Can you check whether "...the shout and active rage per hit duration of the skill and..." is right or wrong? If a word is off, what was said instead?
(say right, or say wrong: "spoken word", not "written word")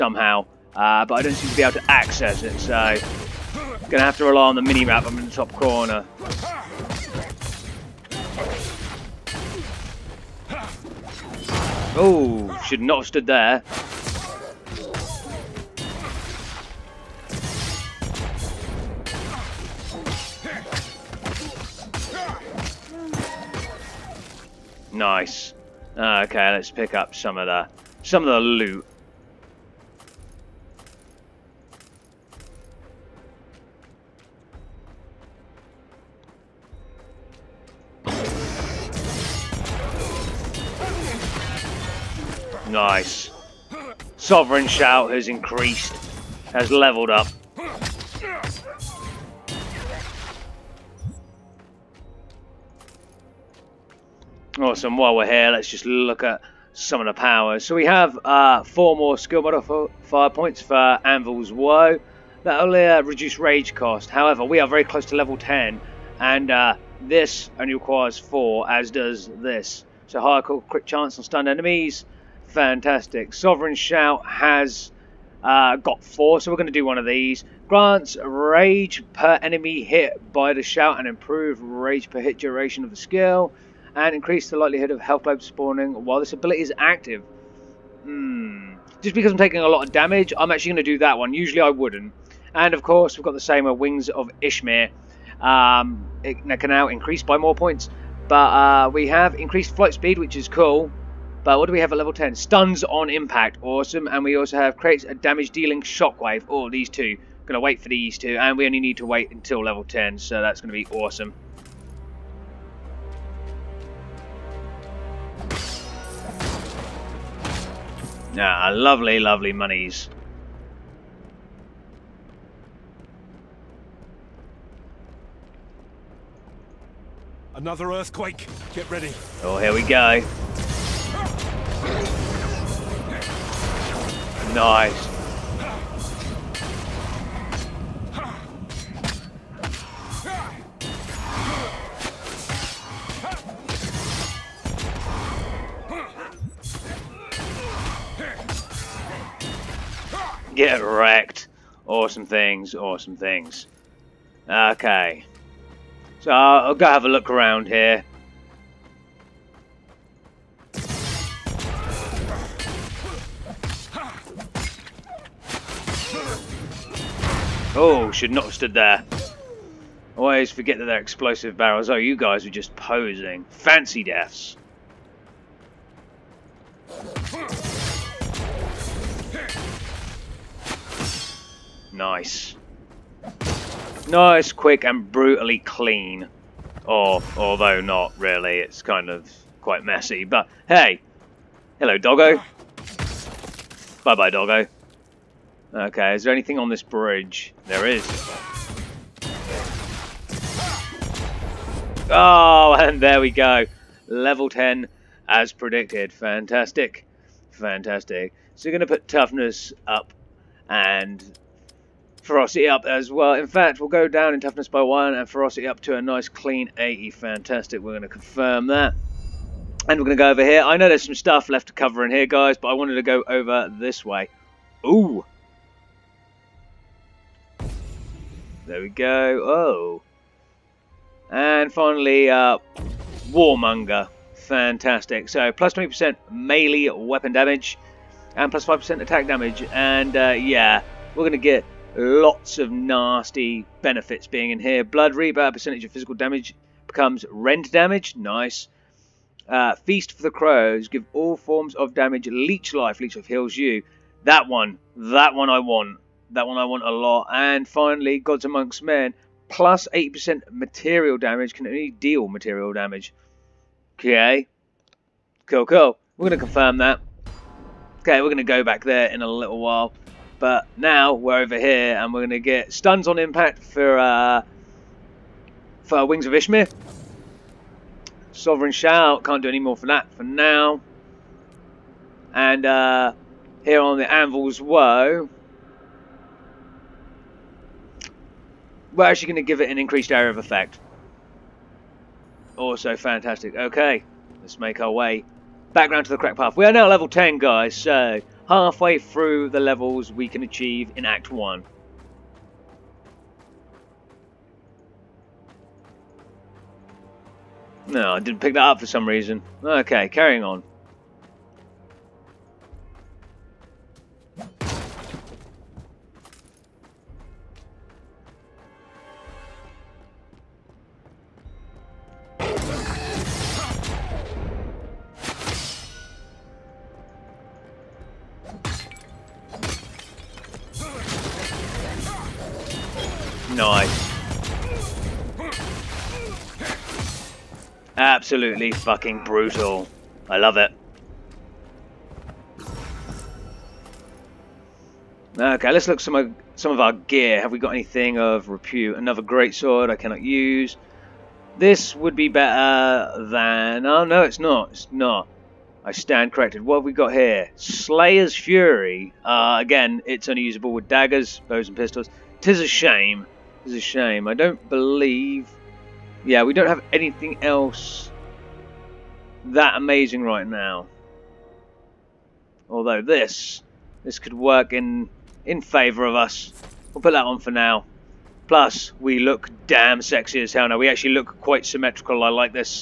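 wrong: "improve", not "active".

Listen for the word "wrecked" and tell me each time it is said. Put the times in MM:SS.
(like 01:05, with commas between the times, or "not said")
02:30.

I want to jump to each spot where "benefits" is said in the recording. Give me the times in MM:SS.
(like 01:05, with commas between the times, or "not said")
04:03.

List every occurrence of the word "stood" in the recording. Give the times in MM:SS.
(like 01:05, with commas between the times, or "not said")
00:13, 02:48.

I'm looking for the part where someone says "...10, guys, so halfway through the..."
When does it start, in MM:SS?
04:57.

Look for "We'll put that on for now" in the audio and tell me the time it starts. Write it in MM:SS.
06:16.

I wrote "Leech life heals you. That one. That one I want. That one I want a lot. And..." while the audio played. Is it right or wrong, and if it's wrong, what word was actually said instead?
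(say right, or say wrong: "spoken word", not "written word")
right.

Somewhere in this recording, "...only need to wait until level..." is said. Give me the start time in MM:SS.
01:48.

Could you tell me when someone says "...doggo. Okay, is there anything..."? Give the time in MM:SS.
03:14.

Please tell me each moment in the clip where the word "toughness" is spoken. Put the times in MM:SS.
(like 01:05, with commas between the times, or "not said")
03:29, 03:34.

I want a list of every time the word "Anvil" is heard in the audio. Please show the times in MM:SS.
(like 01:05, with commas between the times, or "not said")
01:01, 04:44.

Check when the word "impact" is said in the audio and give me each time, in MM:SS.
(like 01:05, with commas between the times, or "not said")
01:43, 04:33.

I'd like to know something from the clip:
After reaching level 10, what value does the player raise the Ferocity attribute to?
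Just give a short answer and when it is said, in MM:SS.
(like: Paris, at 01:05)
80, at 03:35.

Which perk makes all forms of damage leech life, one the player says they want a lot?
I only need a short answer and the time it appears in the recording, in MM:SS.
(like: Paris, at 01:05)
Feast for the Crows, at 04:09.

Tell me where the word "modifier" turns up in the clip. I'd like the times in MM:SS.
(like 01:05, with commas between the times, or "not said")
00:59.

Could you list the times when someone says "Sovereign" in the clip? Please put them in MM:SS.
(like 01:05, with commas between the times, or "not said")
00:44, 01:13, 04:38.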